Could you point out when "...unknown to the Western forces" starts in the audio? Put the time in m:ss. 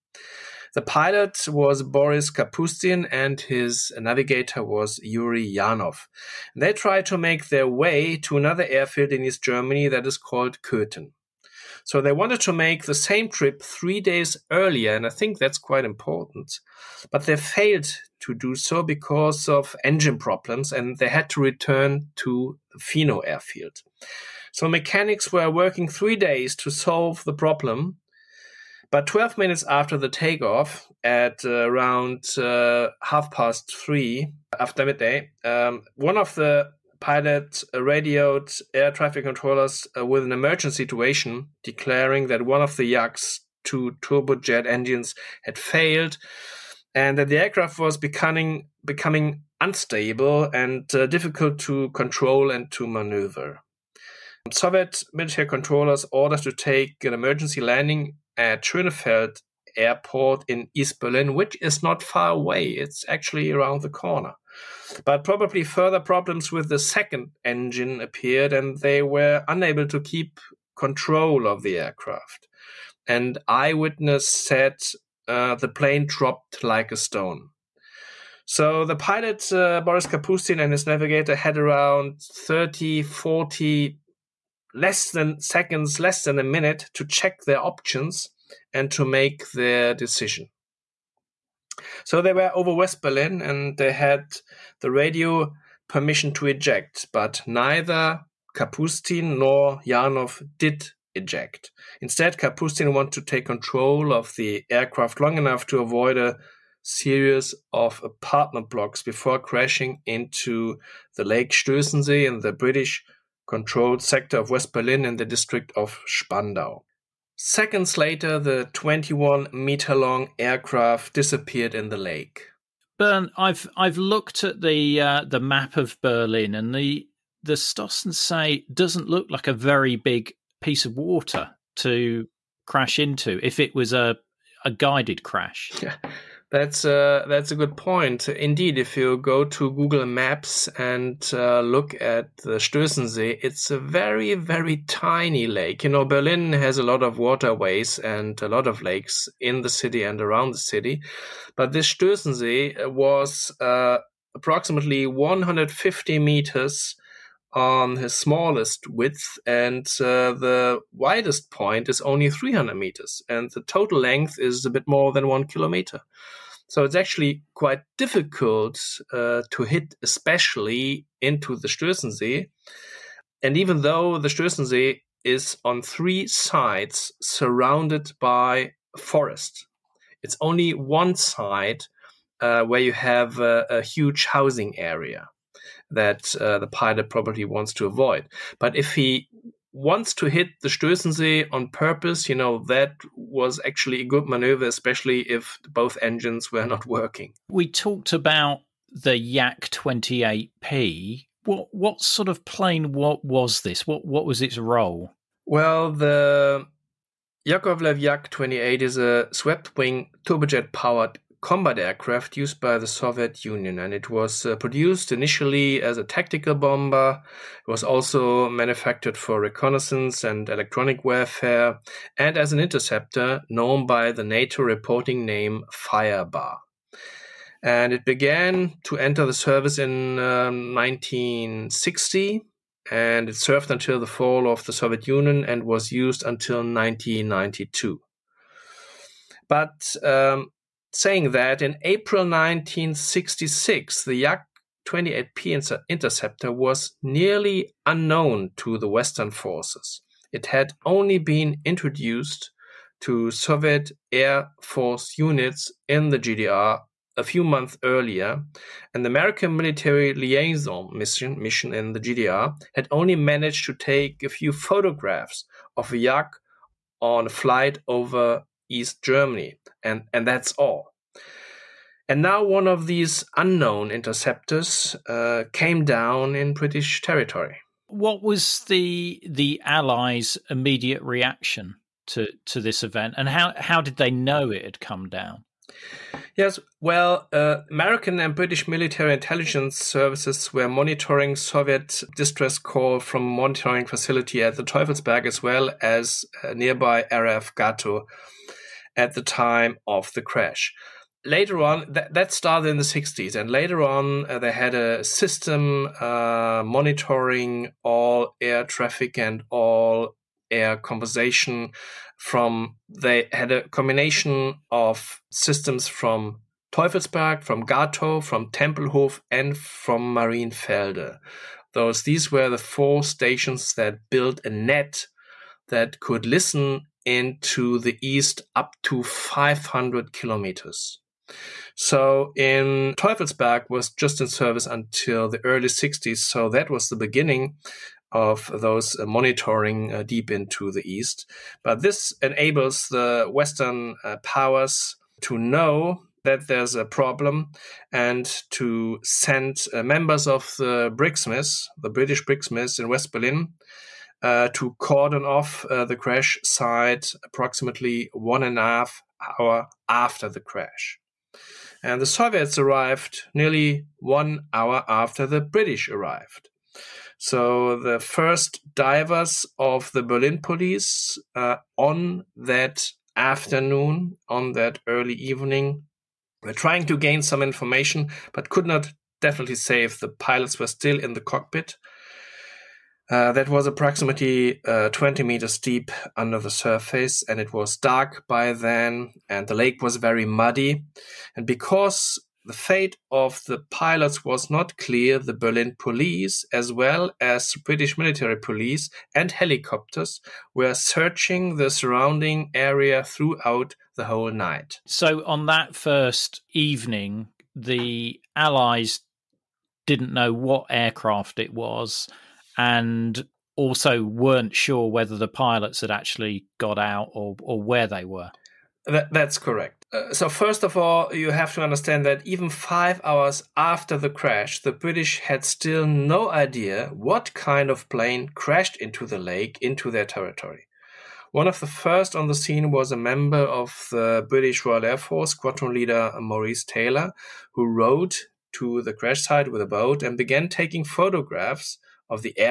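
4:07.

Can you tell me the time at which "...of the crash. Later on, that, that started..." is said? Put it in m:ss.
4:59.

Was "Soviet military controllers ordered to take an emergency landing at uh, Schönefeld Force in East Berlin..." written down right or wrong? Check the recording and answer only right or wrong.
wrong.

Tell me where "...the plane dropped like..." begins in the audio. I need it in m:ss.
1:15.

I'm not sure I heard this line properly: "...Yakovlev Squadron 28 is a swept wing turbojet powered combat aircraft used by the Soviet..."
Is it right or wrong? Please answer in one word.
wrong.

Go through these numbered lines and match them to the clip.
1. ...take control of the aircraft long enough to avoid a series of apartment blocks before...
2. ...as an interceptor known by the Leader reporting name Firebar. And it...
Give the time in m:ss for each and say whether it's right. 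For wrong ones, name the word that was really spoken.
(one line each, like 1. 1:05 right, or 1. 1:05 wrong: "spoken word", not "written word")
1. 1:43 right
2. 3:42 wrong: "NATO", not "Leader".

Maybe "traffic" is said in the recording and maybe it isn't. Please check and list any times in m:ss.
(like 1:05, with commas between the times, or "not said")
0:38, 5:08.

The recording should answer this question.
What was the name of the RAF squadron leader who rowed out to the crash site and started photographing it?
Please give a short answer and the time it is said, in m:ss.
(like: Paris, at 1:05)
Maurice Taylor, at 7:16.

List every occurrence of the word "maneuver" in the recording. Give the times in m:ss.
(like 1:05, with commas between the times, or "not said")
0:52, 3:14.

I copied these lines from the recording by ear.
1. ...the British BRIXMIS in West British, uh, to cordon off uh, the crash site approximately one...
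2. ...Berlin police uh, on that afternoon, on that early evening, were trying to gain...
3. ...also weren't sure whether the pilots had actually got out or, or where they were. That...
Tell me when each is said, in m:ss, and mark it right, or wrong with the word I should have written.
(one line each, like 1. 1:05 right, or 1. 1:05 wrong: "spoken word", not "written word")
1. 5:51 wrong: "Berlin", not "British"
2. 6:10 right
3. 6:53 right.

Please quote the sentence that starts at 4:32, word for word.
And now one of these unknown interceptors uh, came down in British territory.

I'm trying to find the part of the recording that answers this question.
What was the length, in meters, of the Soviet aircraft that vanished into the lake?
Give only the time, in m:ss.
1:58.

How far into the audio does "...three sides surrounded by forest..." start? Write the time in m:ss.
2:55.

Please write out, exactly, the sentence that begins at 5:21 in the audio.
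Those these were the four stations that built a net that could listen and to the east up to 500 kilometers.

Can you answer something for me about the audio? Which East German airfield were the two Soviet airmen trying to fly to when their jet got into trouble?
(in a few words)
Köthen.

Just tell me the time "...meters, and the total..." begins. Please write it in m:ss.
2:42.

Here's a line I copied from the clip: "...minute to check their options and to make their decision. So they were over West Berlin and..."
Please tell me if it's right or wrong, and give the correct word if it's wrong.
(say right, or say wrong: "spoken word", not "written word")
right.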